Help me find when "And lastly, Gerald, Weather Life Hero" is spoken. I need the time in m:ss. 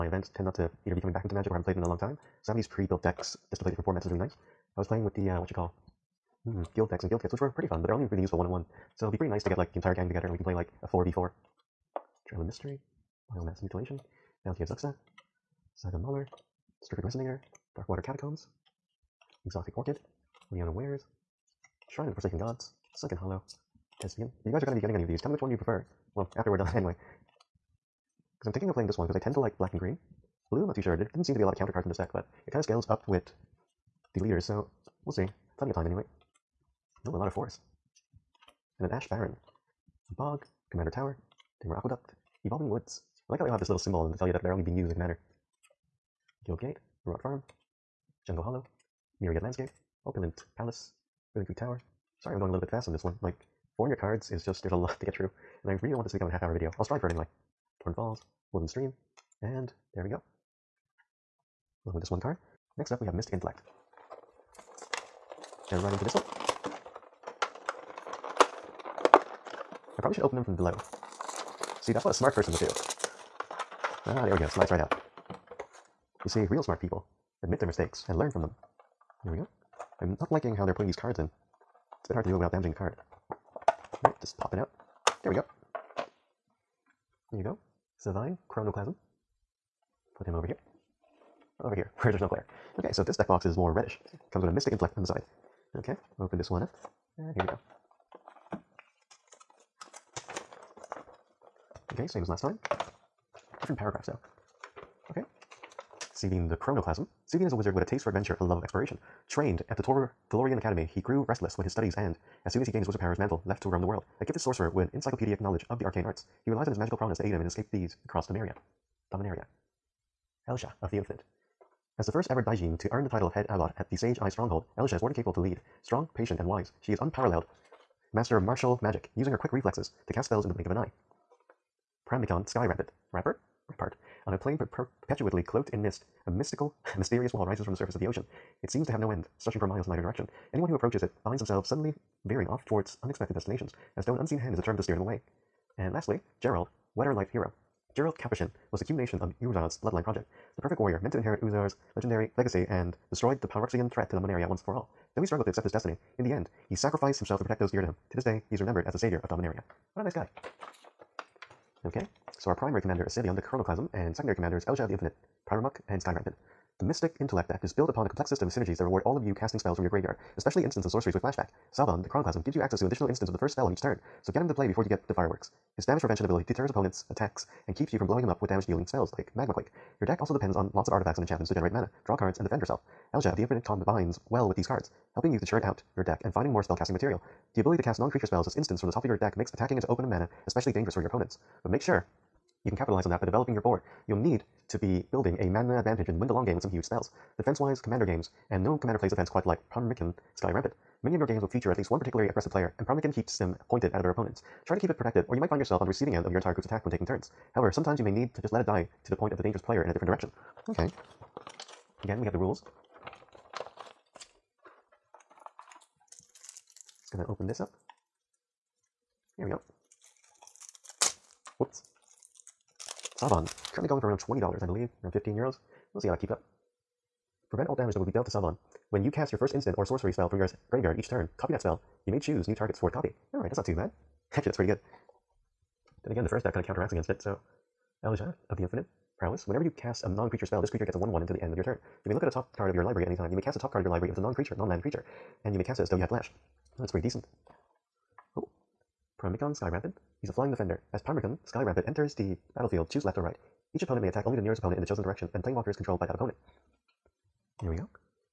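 2:25.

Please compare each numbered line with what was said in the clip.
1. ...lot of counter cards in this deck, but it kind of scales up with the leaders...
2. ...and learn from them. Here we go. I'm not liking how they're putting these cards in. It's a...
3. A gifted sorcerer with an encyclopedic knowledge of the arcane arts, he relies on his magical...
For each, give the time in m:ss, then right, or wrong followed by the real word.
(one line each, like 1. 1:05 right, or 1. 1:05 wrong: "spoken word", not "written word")
1. 0:31 right
2. 1:18 right
3. 1:54 right.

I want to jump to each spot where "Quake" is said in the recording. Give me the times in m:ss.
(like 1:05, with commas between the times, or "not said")
2:59.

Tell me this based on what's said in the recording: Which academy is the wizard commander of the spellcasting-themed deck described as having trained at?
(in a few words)
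Tolarian Academy.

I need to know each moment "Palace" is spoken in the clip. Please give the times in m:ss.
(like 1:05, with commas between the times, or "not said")
0:50.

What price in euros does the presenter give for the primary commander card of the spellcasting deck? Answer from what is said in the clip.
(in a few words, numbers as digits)
15 euros.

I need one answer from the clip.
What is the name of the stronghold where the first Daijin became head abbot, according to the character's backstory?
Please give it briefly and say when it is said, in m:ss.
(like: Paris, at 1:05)
Sage Eye Stronghold, at 2:03.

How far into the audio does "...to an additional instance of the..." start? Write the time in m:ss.
2:52.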